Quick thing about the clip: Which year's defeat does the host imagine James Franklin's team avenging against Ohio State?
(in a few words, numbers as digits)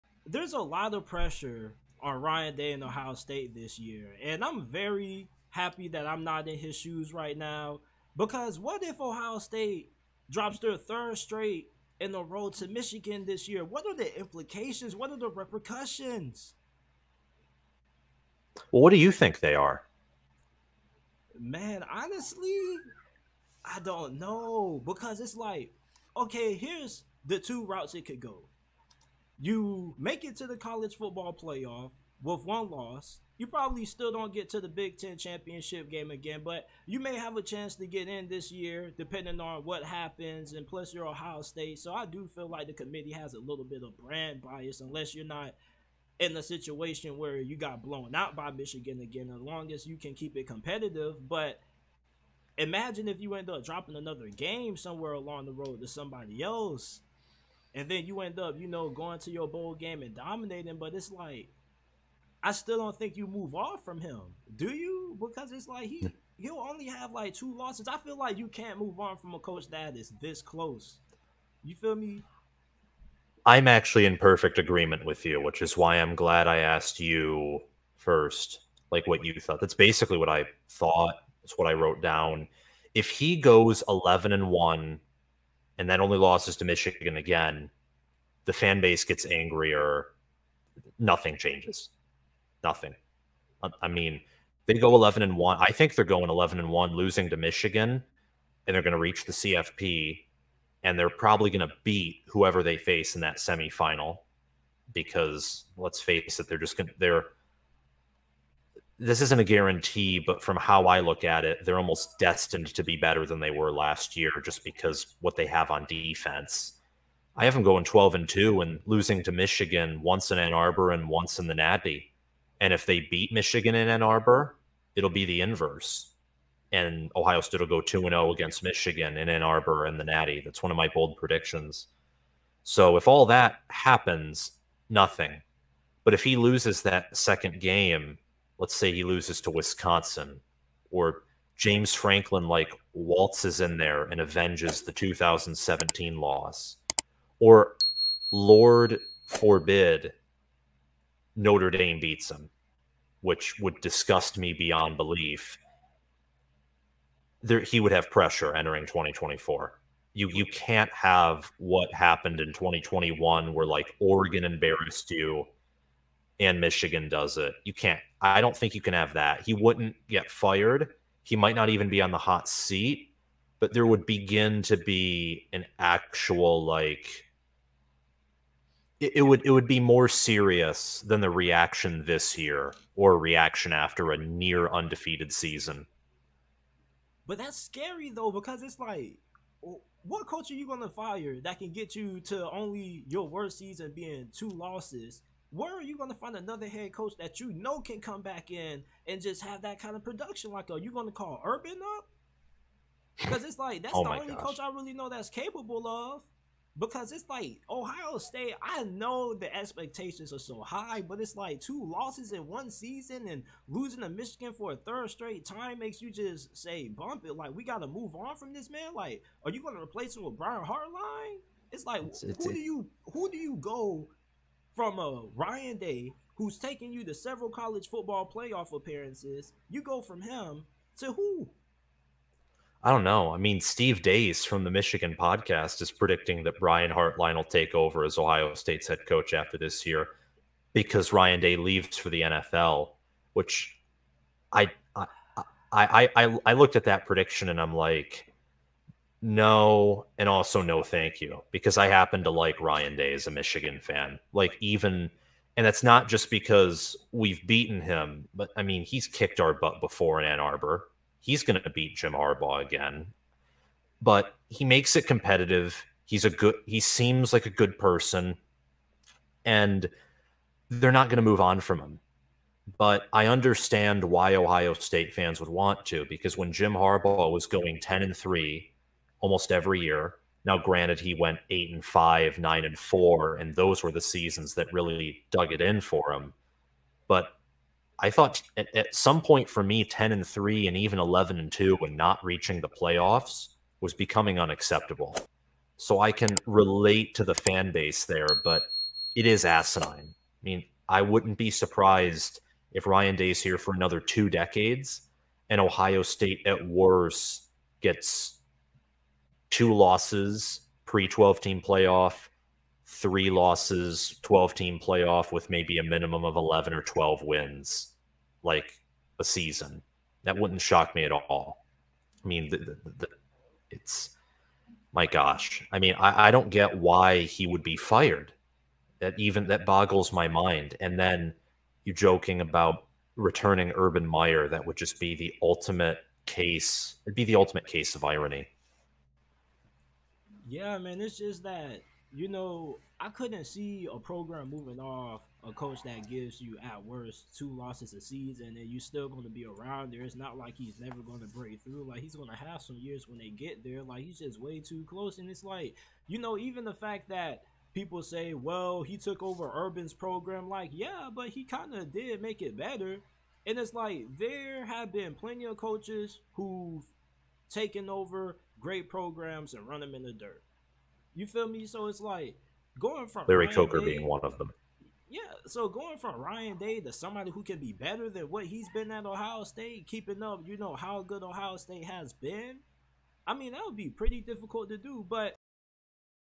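2017.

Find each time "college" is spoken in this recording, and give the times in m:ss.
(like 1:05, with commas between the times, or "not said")
0:30, 3:47.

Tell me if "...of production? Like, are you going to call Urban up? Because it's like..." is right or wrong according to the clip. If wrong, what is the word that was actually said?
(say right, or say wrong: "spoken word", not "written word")
right.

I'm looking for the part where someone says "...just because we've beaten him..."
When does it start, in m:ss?
4:16.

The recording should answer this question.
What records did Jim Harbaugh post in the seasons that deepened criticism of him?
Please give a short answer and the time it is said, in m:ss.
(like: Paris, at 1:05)
8-5 and 9-4, at 4:41.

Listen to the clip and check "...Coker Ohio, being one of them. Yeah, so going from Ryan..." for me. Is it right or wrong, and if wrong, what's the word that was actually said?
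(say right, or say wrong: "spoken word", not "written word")
wrong: "Day", not "Ohio".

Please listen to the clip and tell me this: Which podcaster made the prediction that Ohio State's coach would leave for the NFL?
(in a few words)
Steve Dace.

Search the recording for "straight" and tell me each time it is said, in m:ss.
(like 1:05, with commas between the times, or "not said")
0:11, 3:35.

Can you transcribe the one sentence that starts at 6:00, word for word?
Like, yeah, but he kind of did make it better.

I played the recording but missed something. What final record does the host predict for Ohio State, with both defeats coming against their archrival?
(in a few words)
12-2.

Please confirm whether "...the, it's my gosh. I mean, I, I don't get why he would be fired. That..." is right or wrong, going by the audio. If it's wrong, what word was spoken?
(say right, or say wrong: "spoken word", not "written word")
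right.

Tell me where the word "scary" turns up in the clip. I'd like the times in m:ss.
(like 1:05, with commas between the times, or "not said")
3:07.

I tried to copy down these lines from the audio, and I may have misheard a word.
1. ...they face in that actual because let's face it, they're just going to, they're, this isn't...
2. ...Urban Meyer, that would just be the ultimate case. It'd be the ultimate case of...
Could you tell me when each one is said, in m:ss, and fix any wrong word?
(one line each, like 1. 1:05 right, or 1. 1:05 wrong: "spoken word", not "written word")
1. 1:42 wrong: "semifinal", not "actual"
2. 5:33 right.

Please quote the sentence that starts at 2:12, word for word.
So if all that happens, nothing.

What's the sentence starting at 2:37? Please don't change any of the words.
There, he would have pressure entering 2024.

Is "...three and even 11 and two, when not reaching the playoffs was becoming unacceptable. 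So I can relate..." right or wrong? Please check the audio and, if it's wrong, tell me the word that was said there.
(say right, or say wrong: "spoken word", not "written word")
right.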